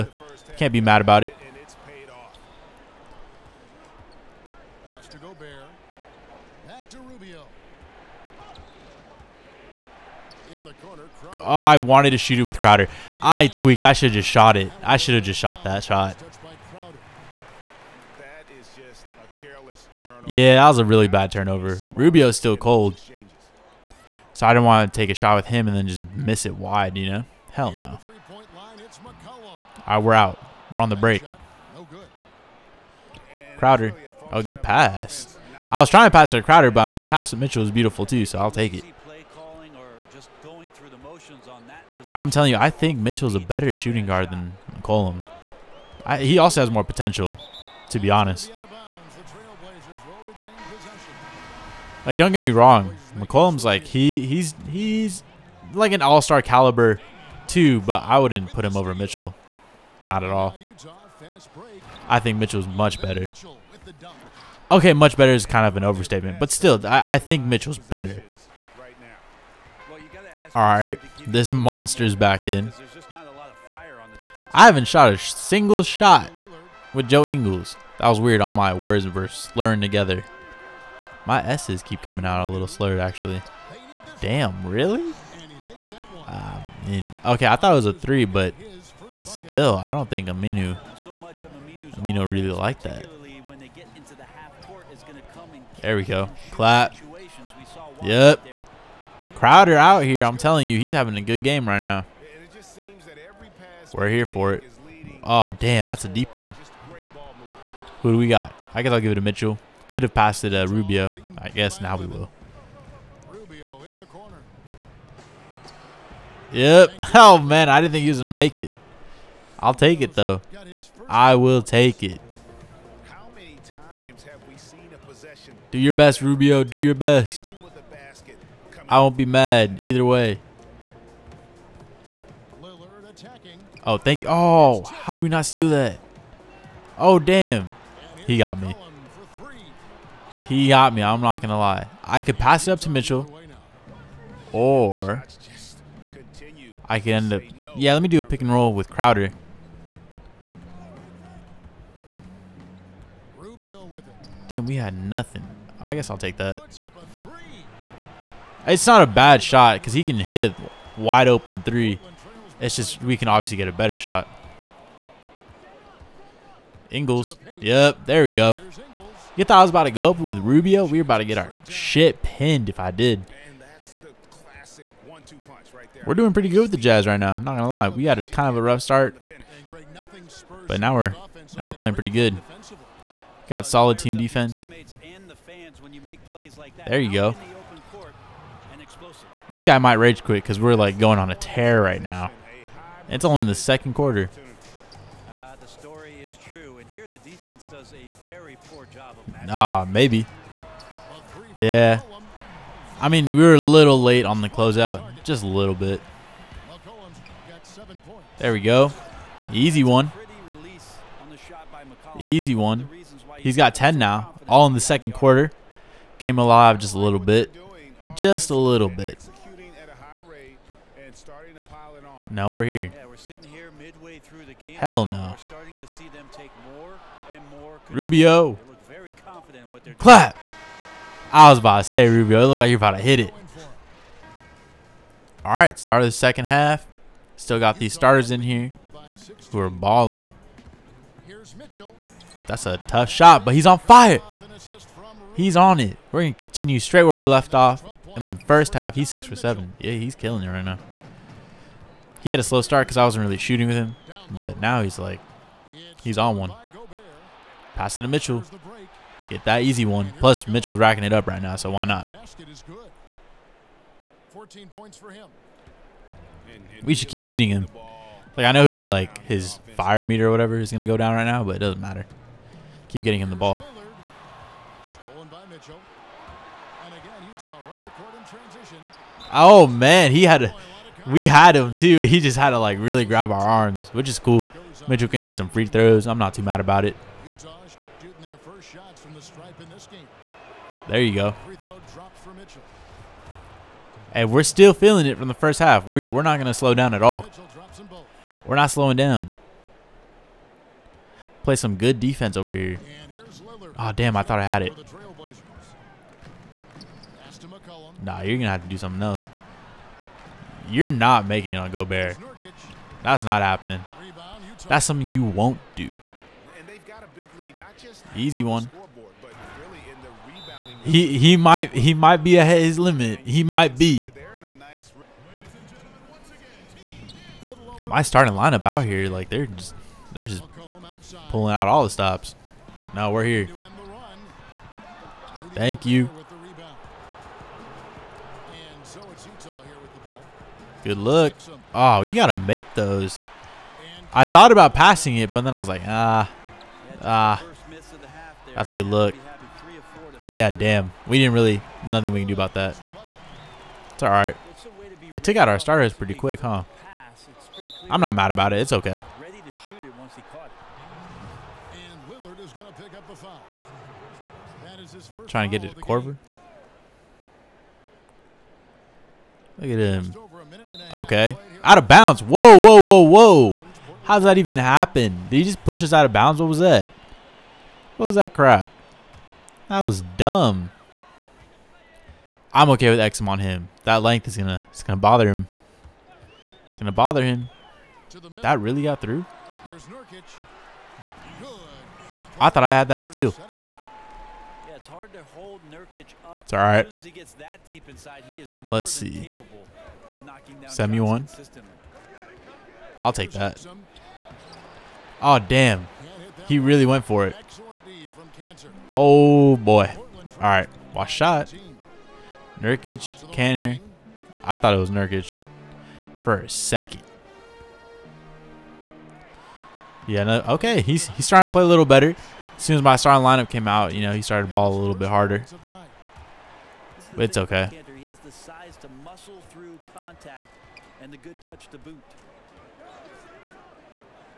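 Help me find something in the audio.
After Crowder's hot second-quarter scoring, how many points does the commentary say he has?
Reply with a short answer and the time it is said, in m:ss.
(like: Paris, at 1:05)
10, at 3:33.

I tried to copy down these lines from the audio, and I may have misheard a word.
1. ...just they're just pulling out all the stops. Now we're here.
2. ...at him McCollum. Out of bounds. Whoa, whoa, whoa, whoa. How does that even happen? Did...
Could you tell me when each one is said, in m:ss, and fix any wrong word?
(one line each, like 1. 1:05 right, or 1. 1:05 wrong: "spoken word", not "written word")
1. 5:29 right
2. 6:09 wrong: "Okay", not "McCollum".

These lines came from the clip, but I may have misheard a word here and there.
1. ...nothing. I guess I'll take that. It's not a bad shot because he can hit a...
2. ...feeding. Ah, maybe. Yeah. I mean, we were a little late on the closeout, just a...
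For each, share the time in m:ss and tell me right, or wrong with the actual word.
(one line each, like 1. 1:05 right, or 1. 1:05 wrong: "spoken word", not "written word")
1. 2:34 right
2. 3:19 wrong: "matching", not "feeding".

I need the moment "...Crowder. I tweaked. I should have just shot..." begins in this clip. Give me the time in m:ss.
0:12.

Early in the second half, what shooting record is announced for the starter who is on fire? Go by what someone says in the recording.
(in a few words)
6 for 7.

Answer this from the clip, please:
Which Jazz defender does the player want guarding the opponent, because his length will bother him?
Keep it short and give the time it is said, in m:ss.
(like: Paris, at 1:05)
Exum, at 6:22.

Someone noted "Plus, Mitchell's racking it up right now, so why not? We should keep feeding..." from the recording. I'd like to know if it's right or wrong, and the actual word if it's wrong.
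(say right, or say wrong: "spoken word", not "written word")
right.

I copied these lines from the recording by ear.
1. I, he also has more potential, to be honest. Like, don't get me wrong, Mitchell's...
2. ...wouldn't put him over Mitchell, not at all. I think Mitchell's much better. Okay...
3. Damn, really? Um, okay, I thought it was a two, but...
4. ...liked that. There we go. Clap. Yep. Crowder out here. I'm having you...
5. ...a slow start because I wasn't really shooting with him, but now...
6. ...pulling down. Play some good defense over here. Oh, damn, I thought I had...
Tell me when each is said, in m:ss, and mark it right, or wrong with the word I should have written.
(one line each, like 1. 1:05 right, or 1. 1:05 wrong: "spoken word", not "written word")
1. 0:46 wrong: "McCollum", not "Mitchell"
2. 0:58 right
3. 1:24 wrong: "three", not "two"
4. 1:32 wrong: "telling", not "having"
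5. 4:12 right
6. 4:58 wrong: "slowing", not "pulling".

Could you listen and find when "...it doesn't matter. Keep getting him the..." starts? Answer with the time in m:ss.
4:31.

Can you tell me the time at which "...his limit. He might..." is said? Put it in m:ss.
5:22.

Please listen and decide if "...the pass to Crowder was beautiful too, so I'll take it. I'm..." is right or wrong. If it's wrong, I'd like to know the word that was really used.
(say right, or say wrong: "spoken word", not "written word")
wrong: "Mitchell", not "Crowder".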